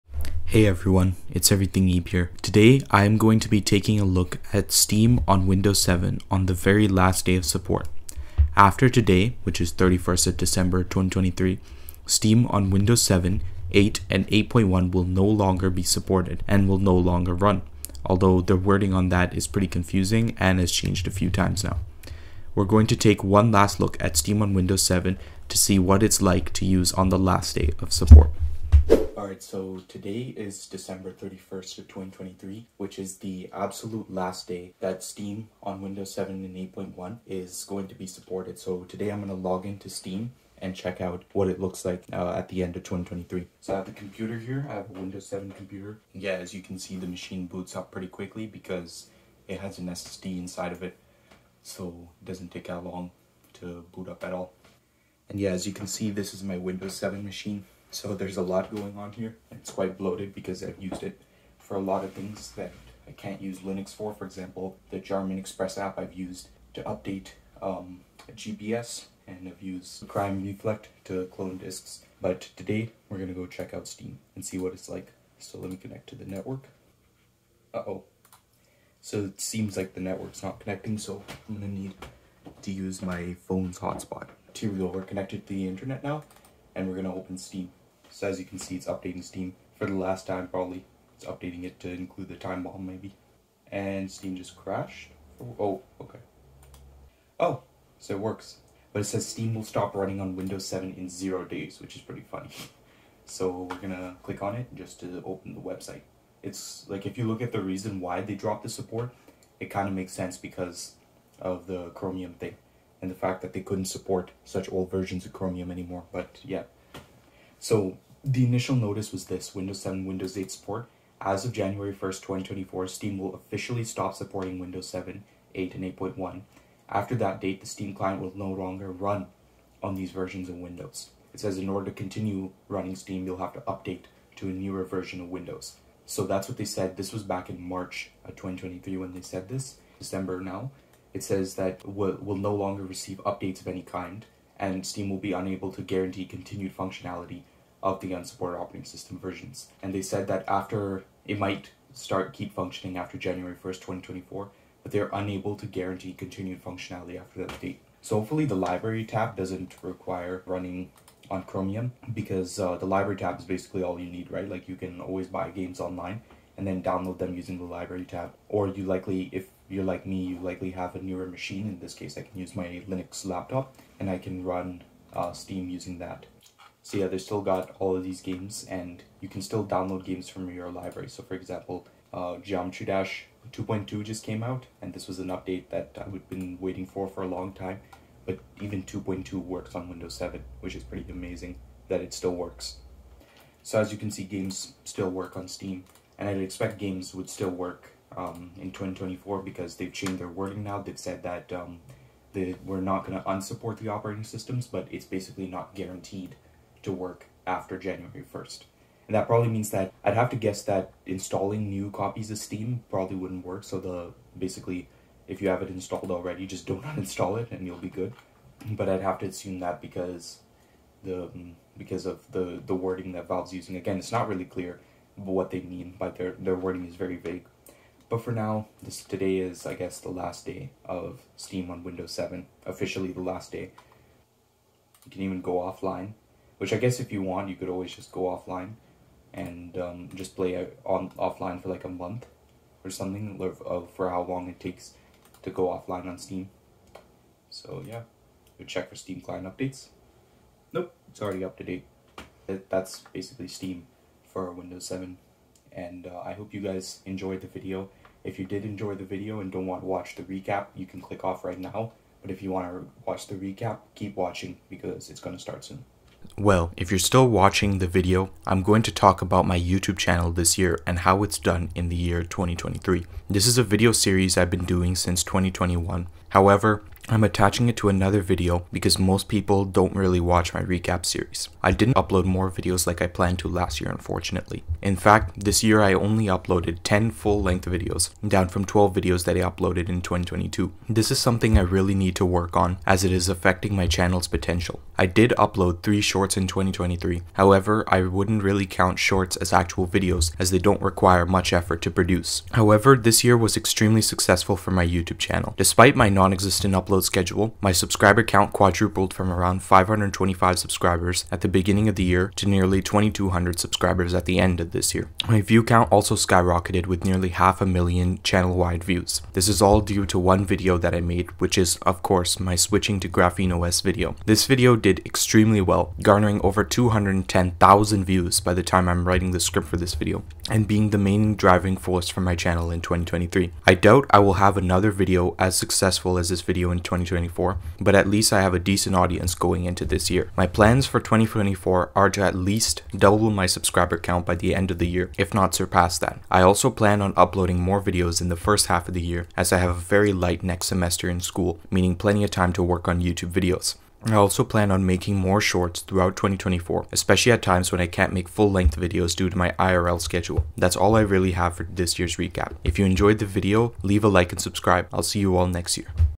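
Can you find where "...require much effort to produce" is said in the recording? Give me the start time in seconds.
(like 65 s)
300 s.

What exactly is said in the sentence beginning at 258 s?
If you did enjoy the video and don't want to watch the recap, you can click off right now.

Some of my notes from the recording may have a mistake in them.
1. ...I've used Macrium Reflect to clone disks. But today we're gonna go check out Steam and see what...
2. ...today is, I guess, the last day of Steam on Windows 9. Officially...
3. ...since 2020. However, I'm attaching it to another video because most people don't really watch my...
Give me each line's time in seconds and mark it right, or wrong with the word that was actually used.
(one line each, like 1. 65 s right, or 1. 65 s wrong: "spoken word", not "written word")
1. 69 s right
2. 229 s wrong: "7", not "9"
3. 274 s wrong: "2021", not "2020".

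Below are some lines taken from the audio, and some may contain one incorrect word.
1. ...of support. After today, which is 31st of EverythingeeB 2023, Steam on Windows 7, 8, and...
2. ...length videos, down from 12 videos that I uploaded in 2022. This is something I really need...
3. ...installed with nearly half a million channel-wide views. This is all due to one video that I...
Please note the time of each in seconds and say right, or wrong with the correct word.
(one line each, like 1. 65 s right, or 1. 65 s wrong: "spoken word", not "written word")
1. 7 s wrong: "December", not "EverythingeeB"
2. 287 s right
3. 316 s wrong: "skyrocketed", not "installed".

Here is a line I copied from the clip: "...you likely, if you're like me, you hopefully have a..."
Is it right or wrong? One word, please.
wrong.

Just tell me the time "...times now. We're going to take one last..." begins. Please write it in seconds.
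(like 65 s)
21 s.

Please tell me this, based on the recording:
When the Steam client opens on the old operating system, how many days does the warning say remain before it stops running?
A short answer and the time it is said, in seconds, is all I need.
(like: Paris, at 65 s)
0, at 101 s.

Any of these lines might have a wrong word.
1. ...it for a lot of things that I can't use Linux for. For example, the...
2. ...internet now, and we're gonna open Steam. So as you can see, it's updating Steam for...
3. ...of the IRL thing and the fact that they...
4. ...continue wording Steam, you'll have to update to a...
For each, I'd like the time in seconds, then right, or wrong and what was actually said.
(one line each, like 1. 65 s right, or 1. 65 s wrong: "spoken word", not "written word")
1. 61 s right
2. 85 s right
3. 111 s wrong: "Chromium", not "IRL"
4. 131 s wrong: "running", not "wording".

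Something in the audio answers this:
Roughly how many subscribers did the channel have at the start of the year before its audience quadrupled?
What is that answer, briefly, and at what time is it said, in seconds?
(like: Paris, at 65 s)
525, at 309 s.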